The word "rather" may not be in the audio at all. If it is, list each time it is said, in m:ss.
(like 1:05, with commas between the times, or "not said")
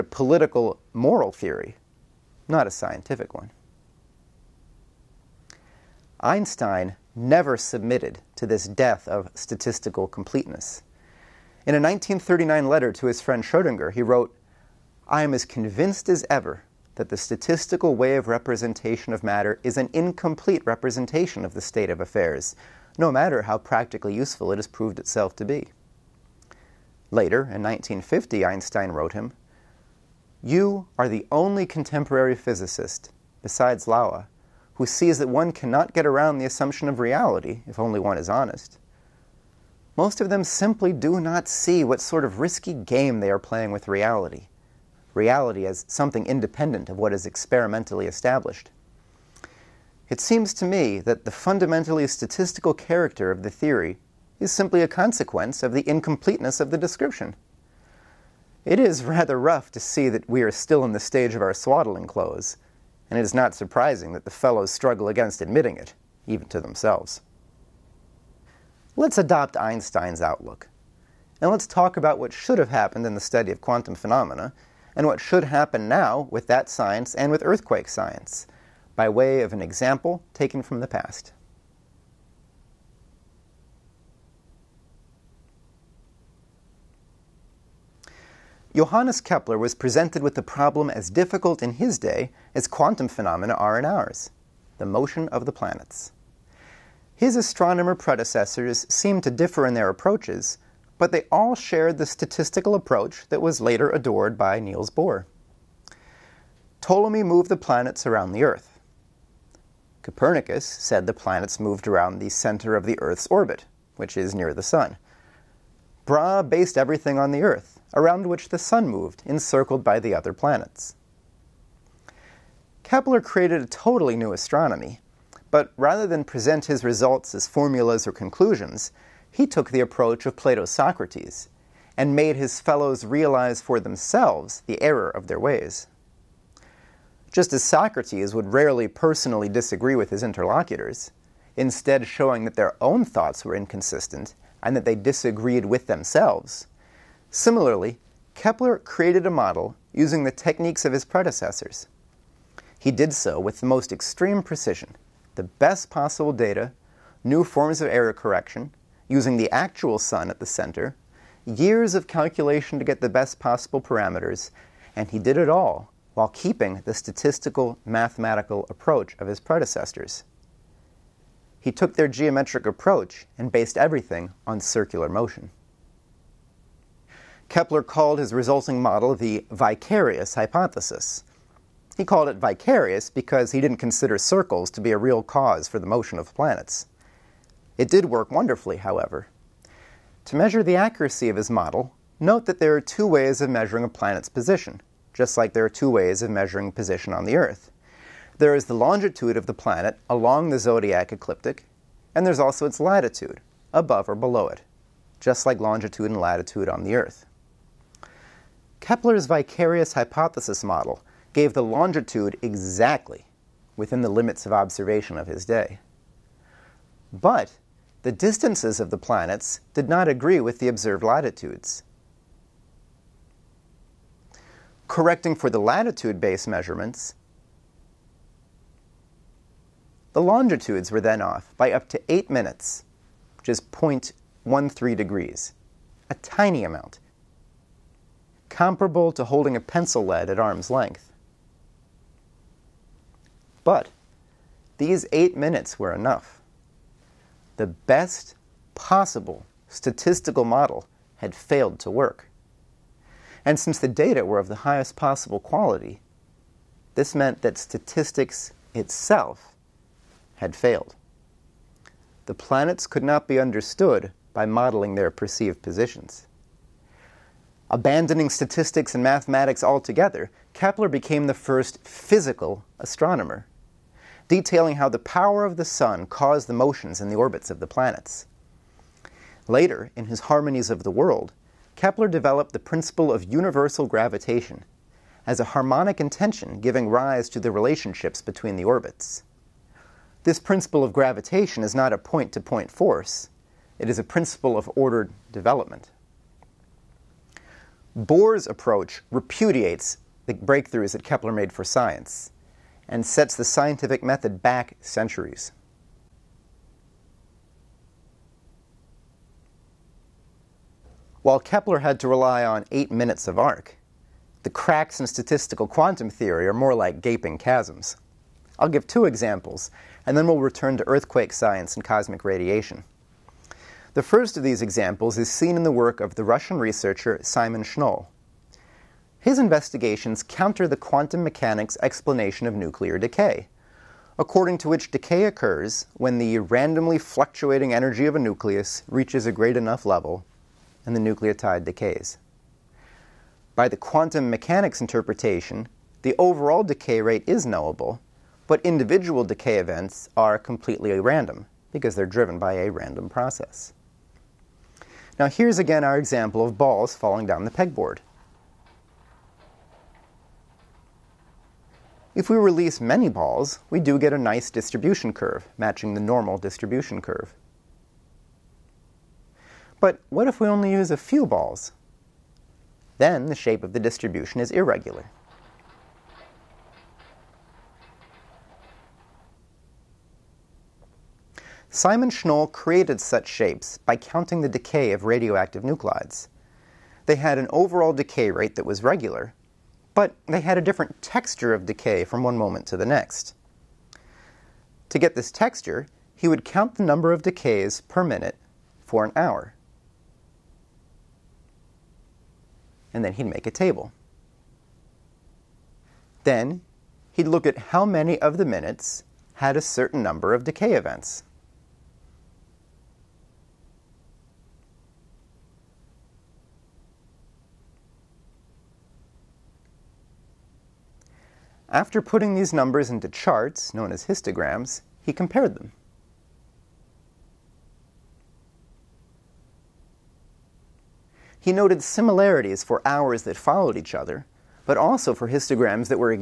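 0:59, 2:05.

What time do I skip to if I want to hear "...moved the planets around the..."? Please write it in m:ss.
1:47.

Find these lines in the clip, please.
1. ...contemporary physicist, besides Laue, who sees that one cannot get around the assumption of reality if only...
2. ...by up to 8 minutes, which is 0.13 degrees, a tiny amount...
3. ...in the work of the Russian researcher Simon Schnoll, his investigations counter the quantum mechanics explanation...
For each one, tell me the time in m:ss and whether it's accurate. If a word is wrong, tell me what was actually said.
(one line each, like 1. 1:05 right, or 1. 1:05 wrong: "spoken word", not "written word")
1. 0:31 right
2. 3:51 right
3. 5:25 right.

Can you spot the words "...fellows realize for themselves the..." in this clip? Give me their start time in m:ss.
2:12.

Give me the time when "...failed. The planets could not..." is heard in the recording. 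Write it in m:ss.
4:20.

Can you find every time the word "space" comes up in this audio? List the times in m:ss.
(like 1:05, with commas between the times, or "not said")
not said.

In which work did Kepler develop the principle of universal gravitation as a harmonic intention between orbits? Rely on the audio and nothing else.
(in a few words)
Harmonies of the World.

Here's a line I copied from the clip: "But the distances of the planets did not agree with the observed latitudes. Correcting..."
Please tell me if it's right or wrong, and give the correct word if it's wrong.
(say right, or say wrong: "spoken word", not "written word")
right.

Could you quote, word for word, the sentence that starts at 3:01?
He called it vicarious because he didn't consider circles to be a real cause for the motion of planets.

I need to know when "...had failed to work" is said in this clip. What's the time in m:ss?
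4:11.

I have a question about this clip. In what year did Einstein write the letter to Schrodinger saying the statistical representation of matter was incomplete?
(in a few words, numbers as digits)
1939.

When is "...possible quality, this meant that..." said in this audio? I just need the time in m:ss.
4:14.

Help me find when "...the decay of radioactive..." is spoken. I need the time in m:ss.
6:24.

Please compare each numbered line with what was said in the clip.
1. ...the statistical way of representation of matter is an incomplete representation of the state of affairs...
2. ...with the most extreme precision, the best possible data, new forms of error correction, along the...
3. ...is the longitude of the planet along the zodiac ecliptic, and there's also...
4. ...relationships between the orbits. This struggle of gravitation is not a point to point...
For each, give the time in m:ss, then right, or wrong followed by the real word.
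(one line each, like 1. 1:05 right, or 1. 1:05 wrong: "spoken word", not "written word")
1. 0:17 right
2. 2:33 wrong: "using", not "along"
3. 3:18 right
4. 4:47 wrong: "principle", not "struggle".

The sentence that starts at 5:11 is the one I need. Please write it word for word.
While Kepler had to rely on eight minutes of arc, the cracks in statistical quantum theory are more like gaping chasms.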